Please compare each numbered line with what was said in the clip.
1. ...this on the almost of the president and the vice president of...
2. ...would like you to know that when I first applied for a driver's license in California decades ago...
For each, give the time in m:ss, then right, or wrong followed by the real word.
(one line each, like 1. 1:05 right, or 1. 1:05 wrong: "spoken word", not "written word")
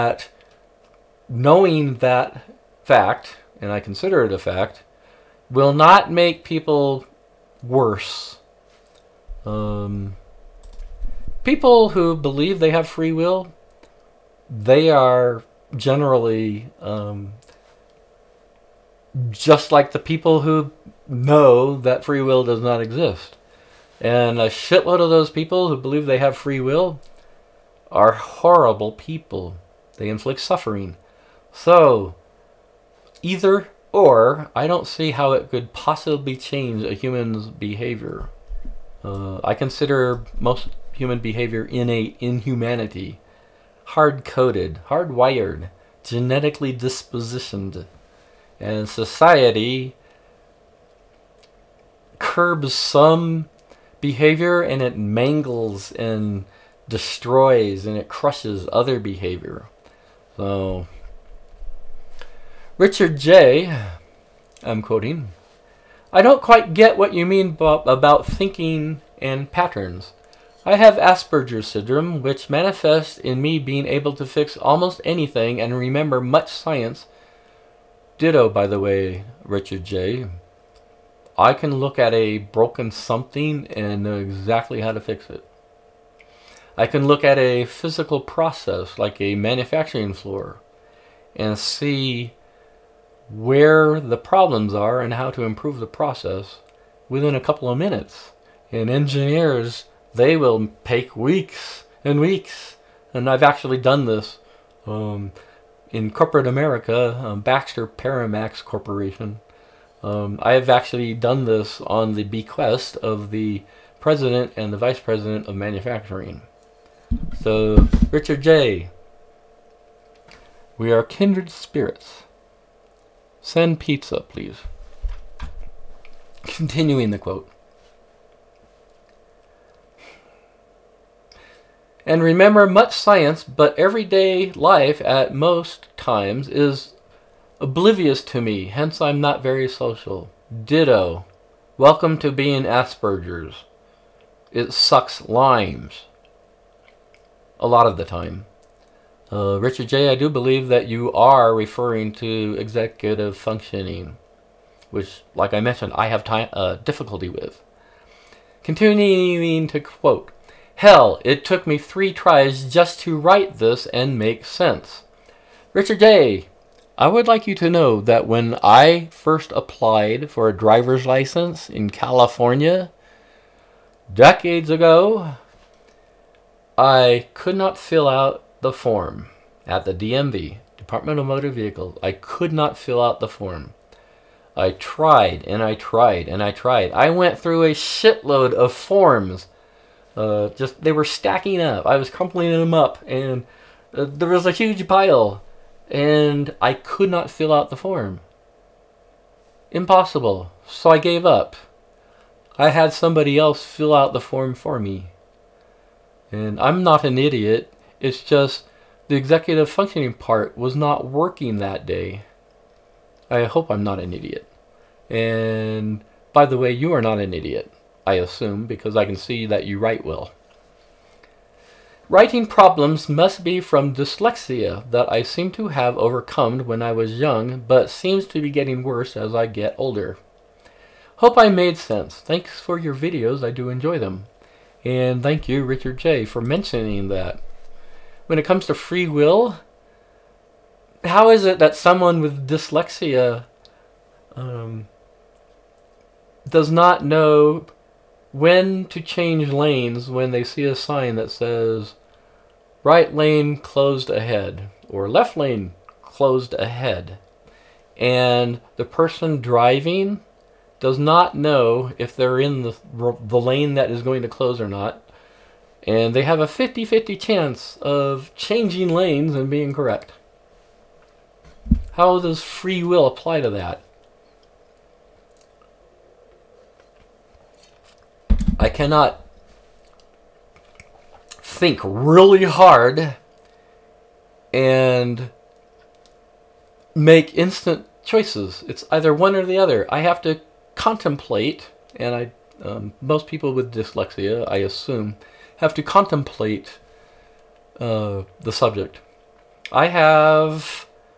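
1. 1:51 wrong: "bequest", not "almost"
2. 2:47 right.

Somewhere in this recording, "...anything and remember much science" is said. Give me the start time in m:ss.
1:15.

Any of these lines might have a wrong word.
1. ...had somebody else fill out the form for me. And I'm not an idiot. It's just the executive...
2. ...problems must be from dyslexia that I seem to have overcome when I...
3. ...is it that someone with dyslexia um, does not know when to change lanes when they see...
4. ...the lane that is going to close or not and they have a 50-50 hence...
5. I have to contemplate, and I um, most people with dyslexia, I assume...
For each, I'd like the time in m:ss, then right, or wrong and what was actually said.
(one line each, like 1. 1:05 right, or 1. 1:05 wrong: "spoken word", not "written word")
1. 3:22 right
2. 3:42 right
3. 4:01 right
4. 4:22 wrong: "chance", not "hence"
5. 4:49 right.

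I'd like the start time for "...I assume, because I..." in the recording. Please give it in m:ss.
3:38.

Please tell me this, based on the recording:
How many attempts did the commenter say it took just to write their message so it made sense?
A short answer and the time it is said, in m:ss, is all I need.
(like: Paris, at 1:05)
3 tries, at 2:41.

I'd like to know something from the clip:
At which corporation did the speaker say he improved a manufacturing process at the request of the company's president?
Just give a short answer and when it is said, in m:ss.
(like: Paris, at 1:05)
Baxter Paramax Corporation, at 1:47.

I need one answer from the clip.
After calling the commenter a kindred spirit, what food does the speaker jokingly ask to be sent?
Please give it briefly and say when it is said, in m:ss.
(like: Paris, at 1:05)
pizza, at 2:03.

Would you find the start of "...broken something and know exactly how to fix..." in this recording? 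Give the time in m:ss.
1:22.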